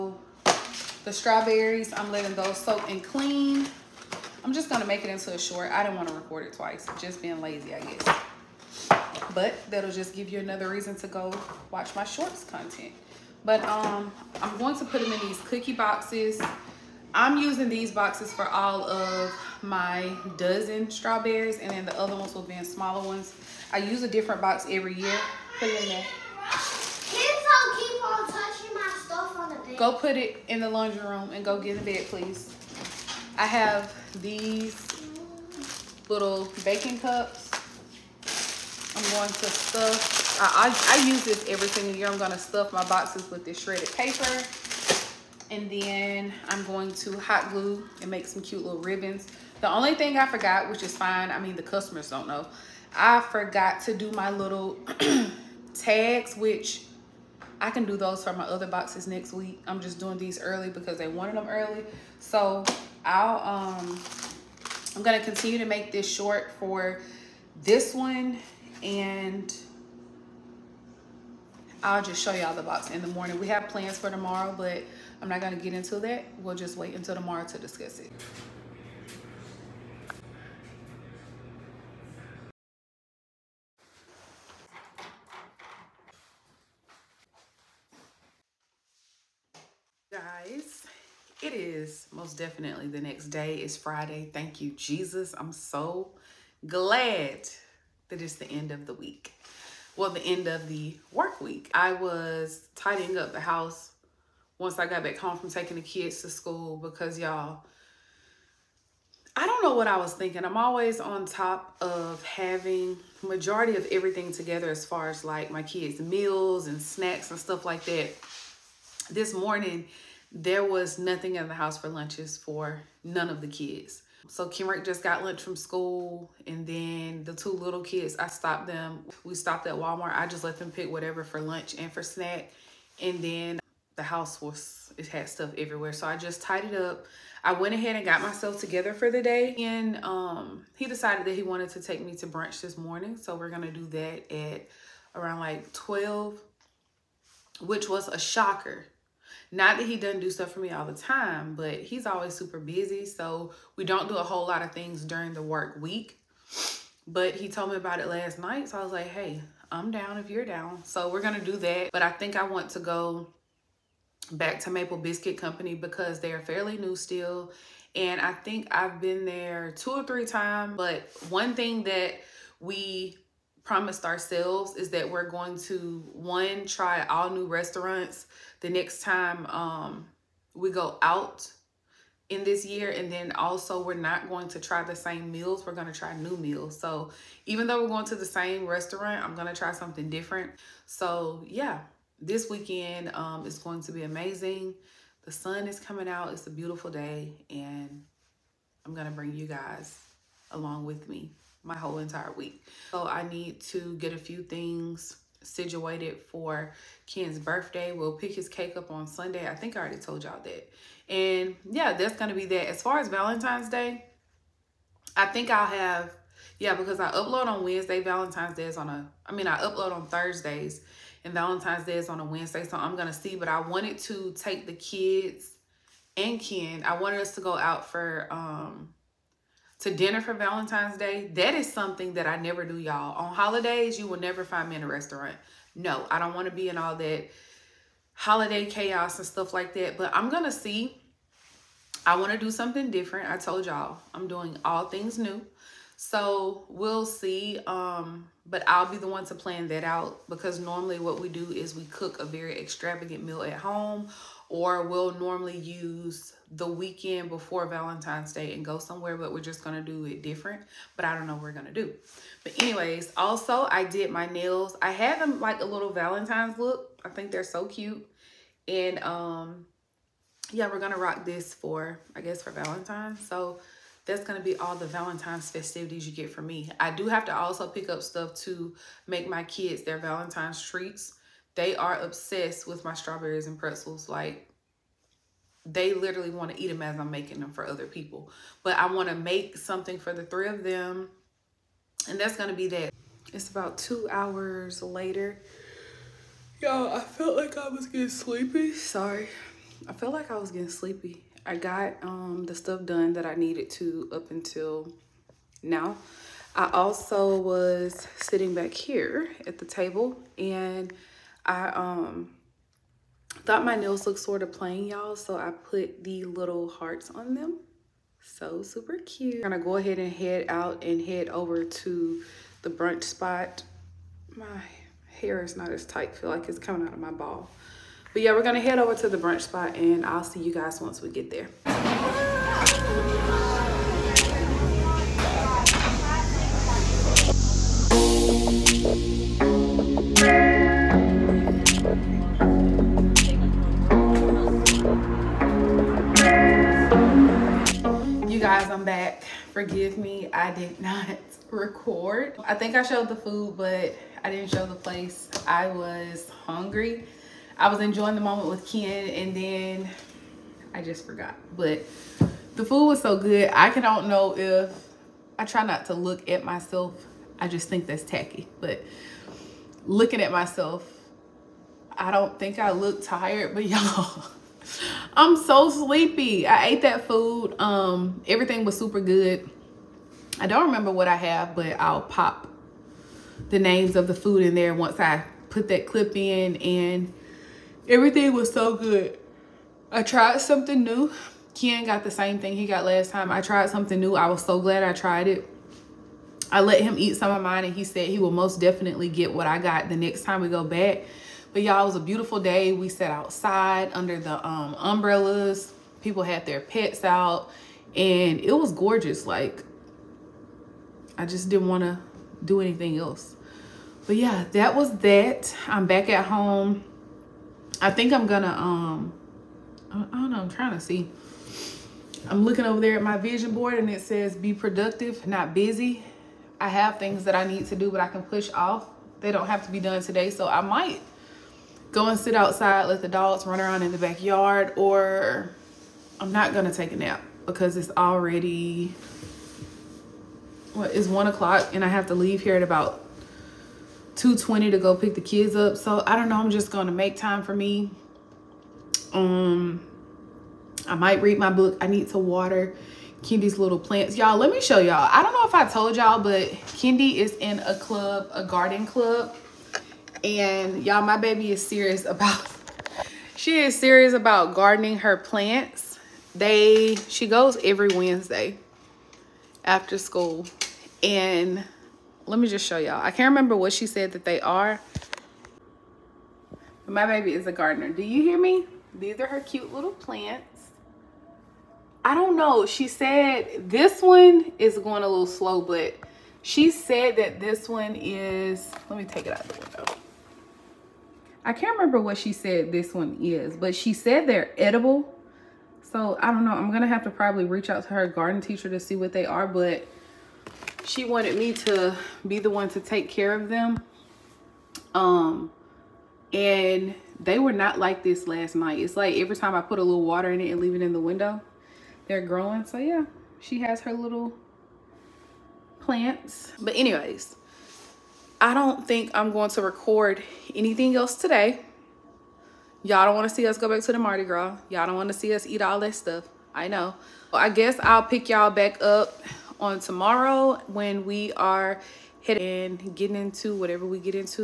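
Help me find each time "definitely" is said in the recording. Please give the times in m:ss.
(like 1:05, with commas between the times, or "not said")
1:32, 6:38.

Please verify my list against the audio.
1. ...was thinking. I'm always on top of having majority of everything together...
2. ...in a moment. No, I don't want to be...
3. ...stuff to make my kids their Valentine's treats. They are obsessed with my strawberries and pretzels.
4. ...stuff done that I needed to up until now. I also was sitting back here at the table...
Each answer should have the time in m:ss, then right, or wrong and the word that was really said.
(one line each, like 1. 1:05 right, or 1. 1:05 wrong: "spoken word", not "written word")
1. 1:49 right
2. 3:54 wrong: "restaurant", not "moment"
3. 4:38 right
4. 5:02 right.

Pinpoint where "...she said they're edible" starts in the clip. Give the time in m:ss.
8:13.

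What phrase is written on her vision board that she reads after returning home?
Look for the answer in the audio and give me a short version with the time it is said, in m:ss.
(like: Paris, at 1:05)
Be productive, not busy, at 7:04.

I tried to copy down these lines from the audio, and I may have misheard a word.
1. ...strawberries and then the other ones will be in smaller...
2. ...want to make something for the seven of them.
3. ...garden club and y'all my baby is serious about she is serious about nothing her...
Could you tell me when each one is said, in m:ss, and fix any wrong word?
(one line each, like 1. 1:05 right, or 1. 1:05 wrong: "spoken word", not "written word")
1. 0:20 right
2. 4:48 wrong: "three", not "seven"
3. 7:38 wrong: "gardening", not "nothing".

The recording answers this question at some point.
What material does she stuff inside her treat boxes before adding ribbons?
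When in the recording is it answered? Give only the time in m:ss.
0:43.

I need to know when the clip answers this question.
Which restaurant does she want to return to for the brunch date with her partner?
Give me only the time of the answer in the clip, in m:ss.
2:44.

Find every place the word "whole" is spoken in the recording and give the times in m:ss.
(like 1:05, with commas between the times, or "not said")
2:34, 3:21.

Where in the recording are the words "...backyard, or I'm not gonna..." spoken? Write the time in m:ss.
7:13.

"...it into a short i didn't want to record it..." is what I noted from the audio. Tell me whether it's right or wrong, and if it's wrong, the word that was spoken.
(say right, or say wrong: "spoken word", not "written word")
right.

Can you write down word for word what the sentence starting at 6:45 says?
People had their pets out and it was gorgeous.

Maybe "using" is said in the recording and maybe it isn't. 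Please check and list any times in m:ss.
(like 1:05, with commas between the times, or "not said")
0:17.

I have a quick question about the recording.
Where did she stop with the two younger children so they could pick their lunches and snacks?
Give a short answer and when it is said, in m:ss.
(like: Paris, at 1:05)
Walmart, at 2:09.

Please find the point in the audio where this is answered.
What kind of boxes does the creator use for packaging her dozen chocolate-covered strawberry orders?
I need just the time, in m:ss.
0:15.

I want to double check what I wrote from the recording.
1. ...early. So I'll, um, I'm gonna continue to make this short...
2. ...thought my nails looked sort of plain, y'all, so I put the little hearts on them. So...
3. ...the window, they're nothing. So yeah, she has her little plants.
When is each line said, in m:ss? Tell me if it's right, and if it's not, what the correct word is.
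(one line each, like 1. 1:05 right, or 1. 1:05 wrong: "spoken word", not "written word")
1. 1:01 right
2. 5:13 right
3. 8:30 wrong: "growing", not "nothing".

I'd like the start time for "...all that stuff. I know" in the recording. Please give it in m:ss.
8:45.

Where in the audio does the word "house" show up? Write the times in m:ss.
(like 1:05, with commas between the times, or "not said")
1:43, 2:01, 2:14.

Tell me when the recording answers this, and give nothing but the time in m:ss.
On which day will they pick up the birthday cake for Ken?
3:29.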